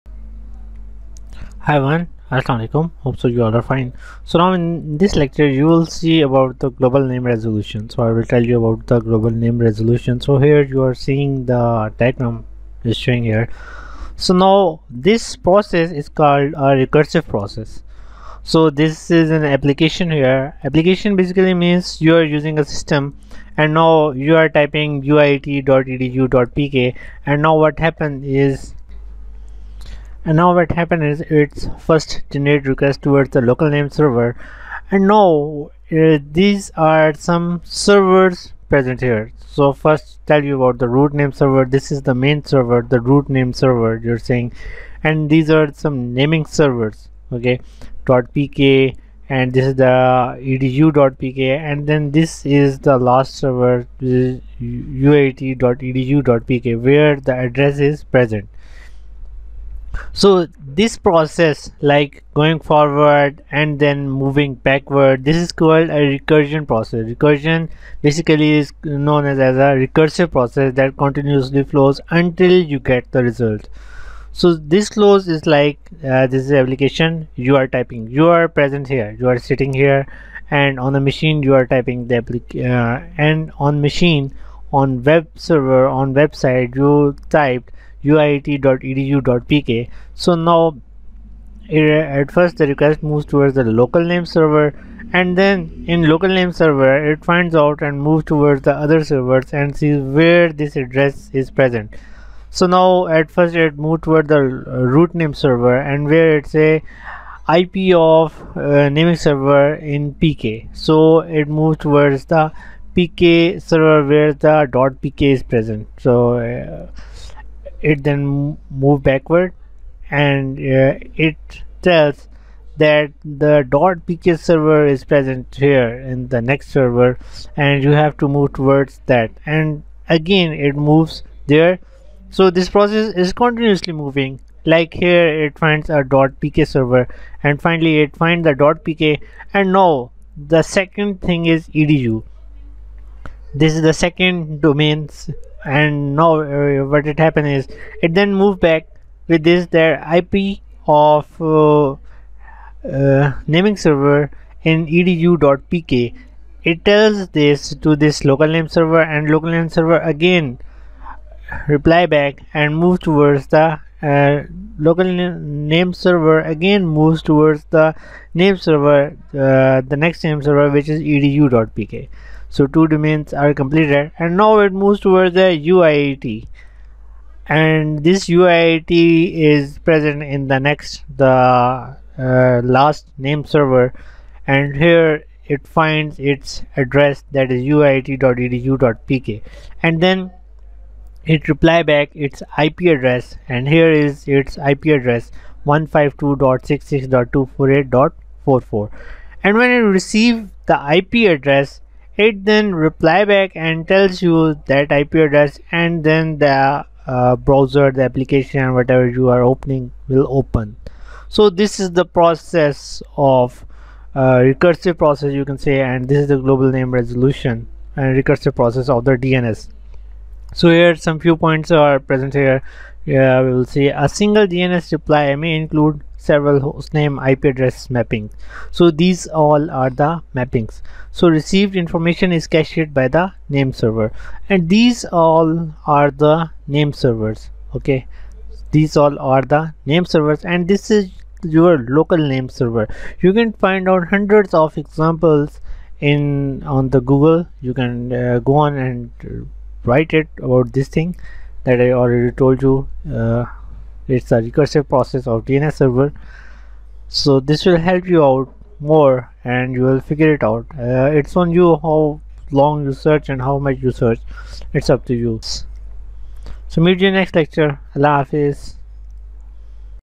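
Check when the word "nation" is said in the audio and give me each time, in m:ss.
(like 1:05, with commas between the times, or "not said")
not said.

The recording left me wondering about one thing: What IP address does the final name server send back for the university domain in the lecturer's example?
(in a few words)
152.66.248.44.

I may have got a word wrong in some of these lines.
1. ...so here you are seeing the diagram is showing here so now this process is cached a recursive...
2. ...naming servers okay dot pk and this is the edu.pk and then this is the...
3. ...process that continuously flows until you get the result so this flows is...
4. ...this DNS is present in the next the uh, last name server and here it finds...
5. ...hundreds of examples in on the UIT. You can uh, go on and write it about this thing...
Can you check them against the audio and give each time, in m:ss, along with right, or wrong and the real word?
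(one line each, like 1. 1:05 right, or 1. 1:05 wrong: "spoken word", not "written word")
1. 0:10 wrong: "called", not "cached"
2. 0:46 right
3. 1:10 right
4. 2:58 wrong: "UIT", not "DNS"
5. 4:04 wrong: "Google", not "UIT".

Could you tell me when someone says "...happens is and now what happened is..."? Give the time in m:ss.
0:27.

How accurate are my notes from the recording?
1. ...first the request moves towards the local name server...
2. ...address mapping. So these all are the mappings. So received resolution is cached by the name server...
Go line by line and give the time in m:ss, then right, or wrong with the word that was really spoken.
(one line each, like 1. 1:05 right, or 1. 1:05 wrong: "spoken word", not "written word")
1. 1:32 right
2. 3:47 wrong: "information", not "resolution".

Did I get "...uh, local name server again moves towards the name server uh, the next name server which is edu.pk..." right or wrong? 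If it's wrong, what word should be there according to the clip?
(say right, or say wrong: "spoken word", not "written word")
right.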